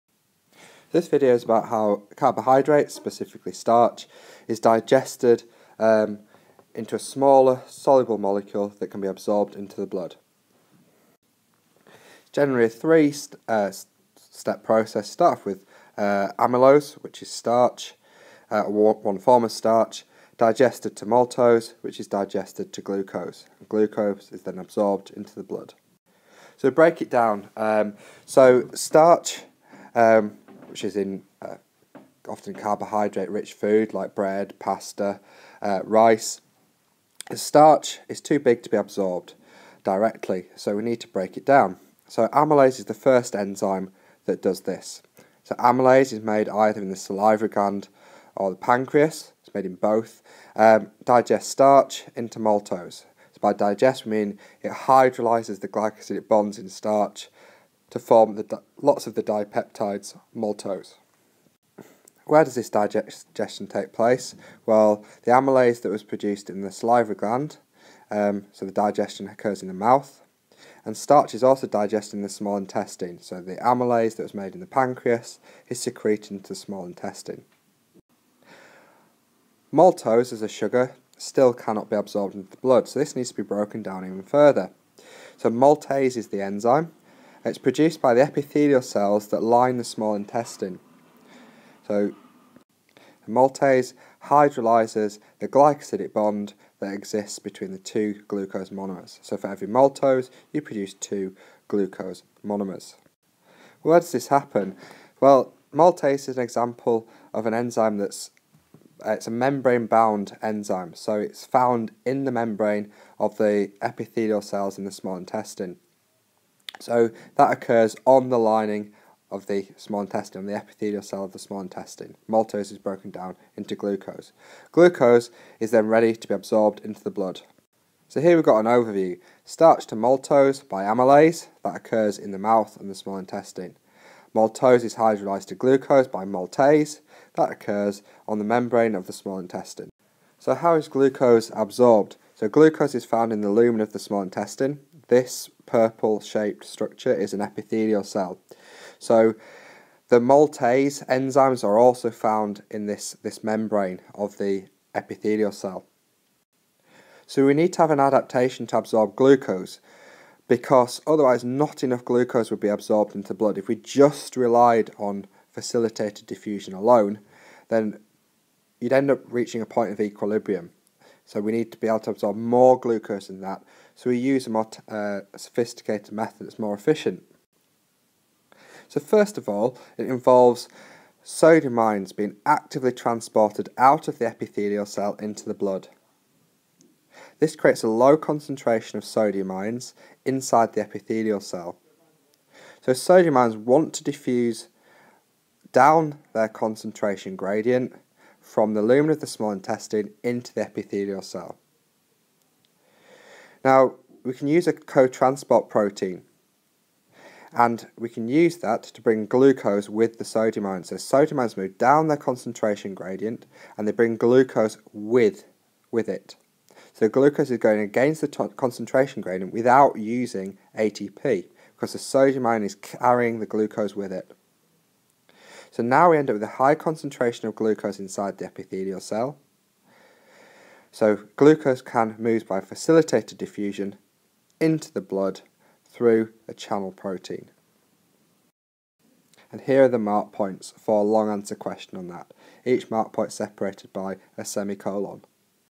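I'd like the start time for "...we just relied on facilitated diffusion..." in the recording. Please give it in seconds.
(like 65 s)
163 s.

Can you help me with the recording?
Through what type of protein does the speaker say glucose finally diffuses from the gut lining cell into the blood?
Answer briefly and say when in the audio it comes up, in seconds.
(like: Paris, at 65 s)
channel protein, at 236 s.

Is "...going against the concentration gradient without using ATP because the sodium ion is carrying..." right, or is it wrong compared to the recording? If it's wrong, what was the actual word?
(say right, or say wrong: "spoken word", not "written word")
right.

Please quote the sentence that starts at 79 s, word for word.
Maltose as a sugar still cannot be absorbed into the blood, so this needs to be broken down even further.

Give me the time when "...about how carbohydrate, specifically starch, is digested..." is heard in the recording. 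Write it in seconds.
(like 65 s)
1 s.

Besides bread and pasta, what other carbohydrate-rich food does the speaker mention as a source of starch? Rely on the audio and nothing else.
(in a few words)
rice.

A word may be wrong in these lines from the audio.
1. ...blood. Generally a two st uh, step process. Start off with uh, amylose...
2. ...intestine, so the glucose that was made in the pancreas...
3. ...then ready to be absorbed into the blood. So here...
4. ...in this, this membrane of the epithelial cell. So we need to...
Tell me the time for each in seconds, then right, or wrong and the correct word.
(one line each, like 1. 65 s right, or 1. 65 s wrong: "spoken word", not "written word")
1. 9 s wrong: "three", not "two"
2. 72 s wrong: "amylase", not "glucose"
3. 125 s right
4. 152 s right.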